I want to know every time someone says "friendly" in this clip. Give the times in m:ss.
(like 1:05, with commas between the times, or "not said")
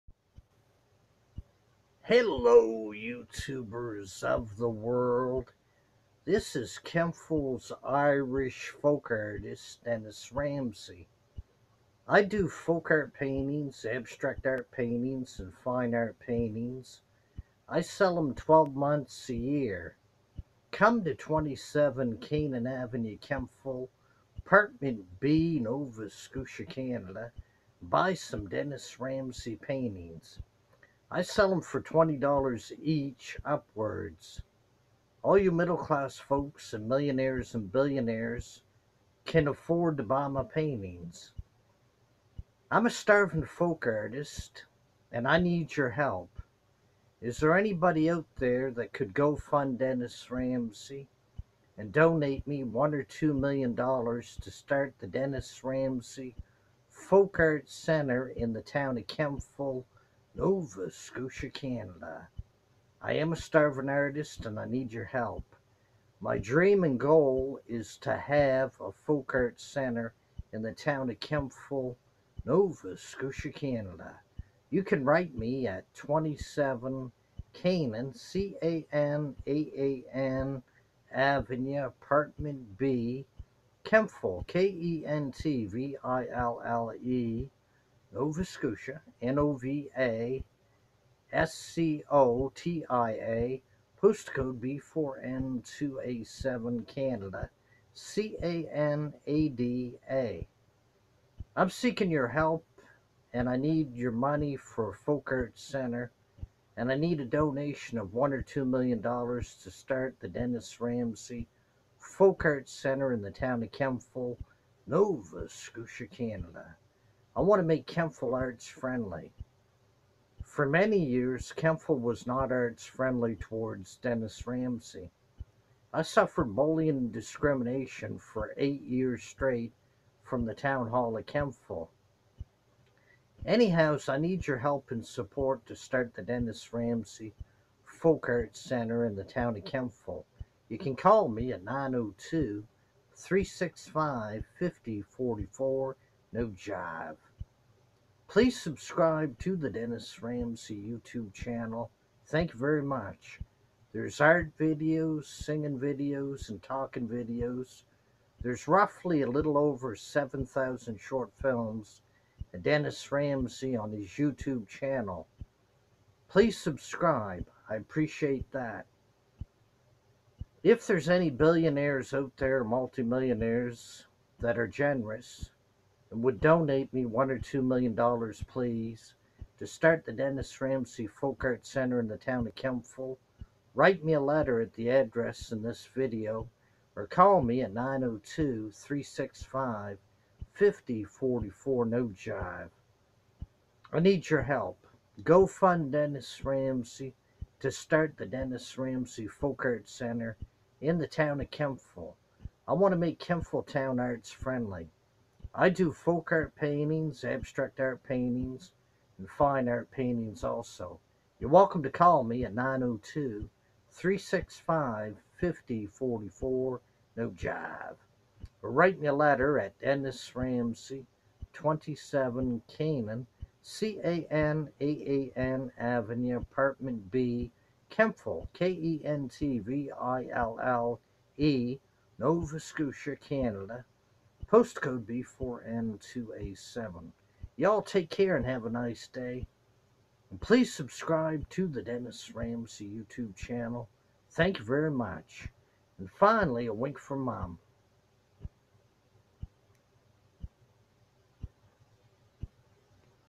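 1:58, 2:02, 3:24.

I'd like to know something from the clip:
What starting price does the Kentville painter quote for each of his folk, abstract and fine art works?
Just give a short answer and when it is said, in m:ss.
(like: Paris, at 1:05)
$20, at 0:31.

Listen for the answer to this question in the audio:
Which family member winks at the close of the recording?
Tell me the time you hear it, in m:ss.
4:07.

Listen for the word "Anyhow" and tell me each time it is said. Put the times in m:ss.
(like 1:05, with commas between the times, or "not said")
2:13.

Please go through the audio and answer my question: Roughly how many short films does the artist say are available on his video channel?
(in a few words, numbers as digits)
7,000.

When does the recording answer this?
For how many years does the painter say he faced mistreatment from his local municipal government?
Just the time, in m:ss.
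2:08.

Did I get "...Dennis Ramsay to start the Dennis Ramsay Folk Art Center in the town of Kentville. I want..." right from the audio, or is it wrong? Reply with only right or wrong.
right.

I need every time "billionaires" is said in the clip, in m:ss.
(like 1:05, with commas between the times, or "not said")
0:37, 2:51.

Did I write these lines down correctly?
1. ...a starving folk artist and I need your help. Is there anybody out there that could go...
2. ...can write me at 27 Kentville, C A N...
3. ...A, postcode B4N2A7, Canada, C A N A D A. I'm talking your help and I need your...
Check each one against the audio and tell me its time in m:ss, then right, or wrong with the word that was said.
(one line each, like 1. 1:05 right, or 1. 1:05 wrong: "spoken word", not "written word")
1. 0:42 right
2. 1:14 wrong: "Canaan", not "Kentville"
3. 1:33 wrong: "seeking", not "talking".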